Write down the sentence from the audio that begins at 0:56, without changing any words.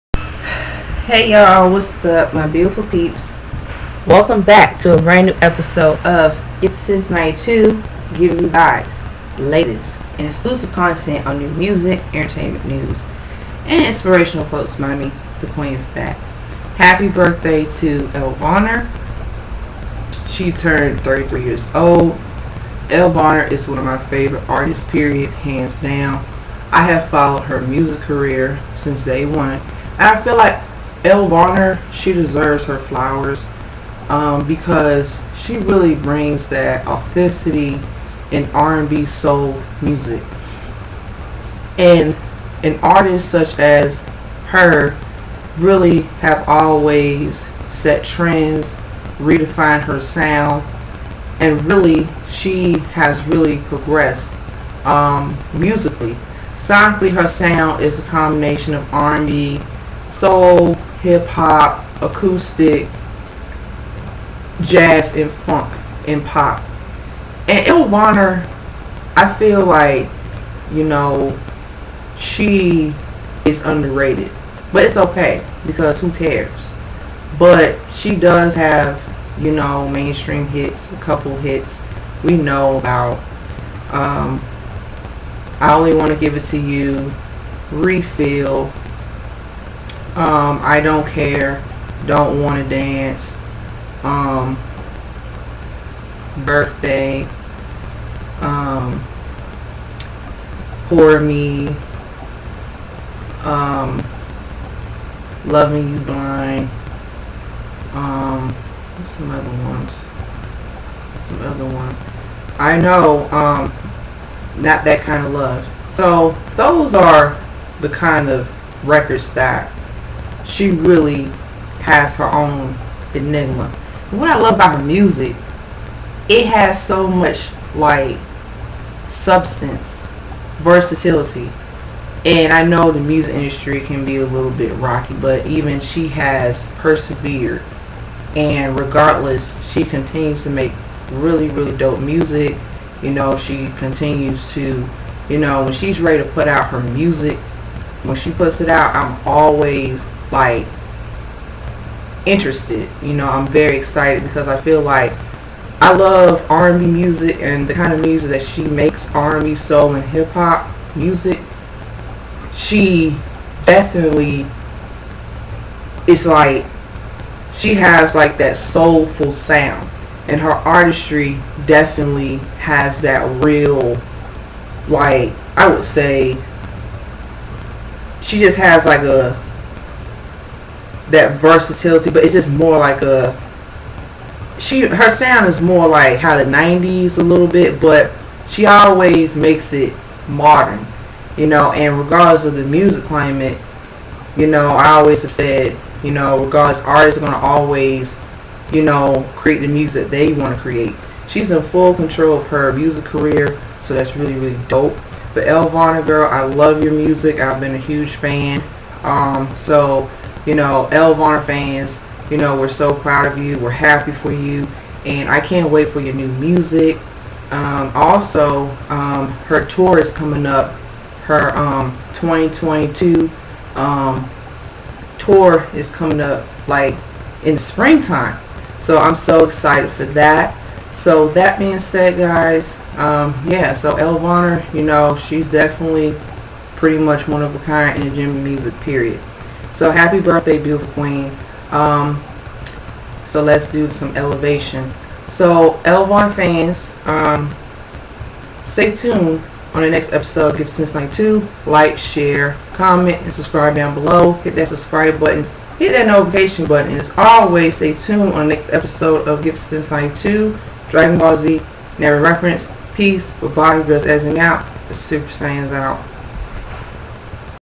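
Sonically, her sound is a combination of R&B, soul, hip hop, acoustic, jazz and funk and pop.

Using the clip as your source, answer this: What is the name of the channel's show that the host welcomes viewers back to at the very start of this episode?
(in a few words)
Since 92.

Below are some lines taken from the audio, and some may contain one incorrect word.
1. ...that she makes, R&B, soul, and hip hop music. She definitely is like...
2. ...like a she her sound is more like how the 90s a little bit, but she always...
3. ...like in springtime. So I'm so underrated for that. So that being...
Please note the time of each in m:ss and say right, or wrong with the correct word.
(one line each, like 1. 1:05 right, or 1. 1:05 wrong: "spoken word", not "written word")
1. 2:38 right
2. 3:02 right
3. 3:46 wrong: "excited", not "underrated".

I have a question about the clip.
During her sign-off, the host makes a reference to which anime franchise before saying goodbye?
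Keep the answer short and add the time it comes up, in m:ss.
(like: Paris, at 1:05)
Dragon Ball Z, at 4:20.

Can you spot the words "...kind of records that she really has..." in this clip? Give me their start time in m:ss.
1:57.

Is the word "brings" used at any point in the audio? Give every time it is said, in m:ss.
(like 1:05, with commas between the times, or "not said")
0:35.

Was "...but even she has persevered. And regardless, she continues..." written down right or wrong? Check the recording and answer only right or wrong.
right.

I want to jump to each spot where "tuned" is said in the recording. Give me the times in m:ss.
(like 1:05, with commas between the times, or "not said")
4:08, 4:17.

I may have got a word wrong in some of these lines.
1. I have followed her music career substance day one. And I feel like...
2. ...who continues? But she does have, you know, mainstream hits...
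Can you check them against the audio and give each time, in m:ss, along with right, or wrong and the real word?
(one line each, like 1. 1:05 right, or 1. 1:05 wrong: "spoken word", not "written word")
1. 0:26 wrong: "since", not "substance"
2. 1:15 wrong: "cares", not "continues".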